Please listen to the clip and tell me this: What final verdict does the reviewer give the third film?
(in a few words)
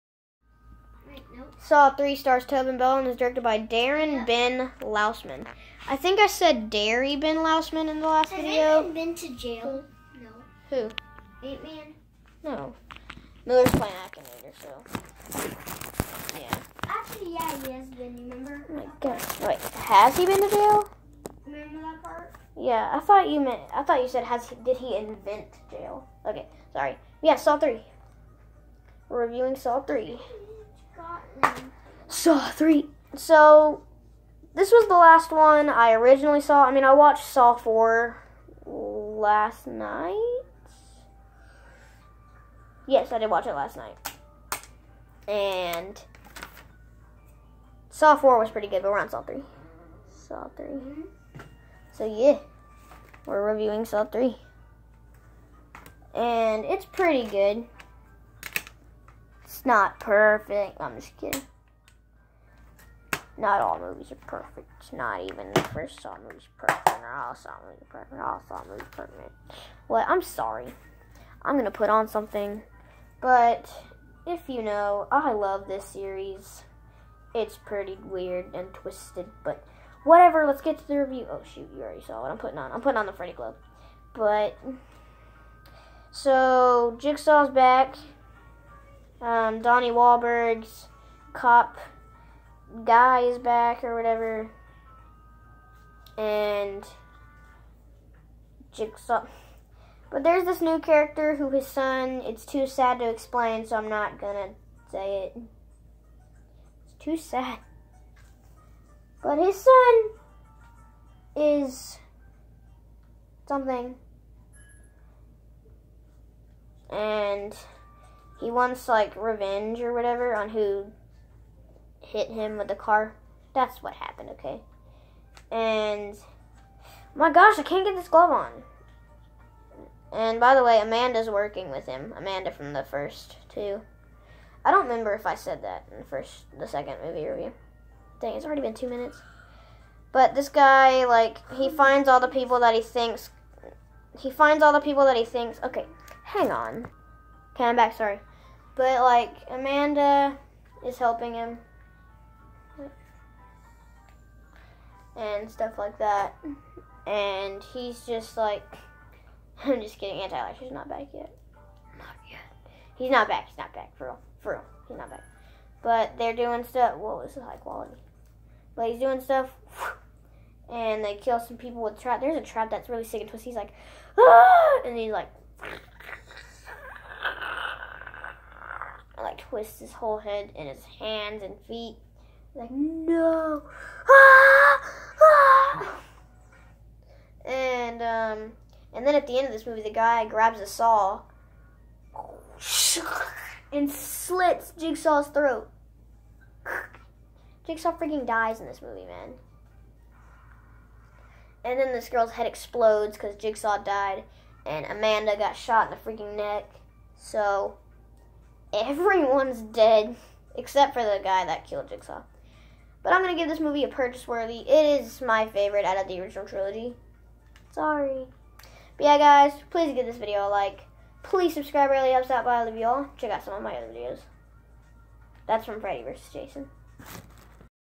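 Purchase worthy.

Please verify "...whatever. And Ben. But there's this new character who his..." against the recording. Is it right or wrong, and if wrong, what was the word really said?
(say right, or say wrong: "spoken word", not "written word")
wrong: "Jigsaw", not "Ben".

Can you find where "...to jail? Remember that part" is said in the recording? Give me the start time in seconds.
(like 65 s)
20 s.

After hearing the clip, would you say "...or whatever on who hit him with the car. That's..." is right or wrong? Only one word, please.
right.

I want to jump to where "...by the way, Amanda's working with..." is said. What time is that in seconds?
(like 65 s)
130 s.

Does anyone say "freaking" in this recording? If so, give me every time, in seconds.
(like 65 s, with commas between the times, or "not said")
197 s, 206 s.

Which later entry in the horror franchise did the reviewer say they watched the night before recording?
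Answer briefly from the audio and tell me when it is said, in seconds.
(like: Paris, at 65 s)
Saw 4, at 37 s.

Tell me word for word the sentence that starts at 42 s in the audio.
Yes, I did watch it last night.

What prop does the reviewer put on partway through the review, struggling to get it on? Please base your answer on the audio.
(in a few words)
The Freddy glove.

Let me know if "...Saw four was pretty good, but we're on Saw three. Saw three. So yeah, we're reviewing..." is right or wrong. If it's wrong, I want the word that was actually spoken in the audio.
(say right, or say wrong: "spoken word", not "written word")
right.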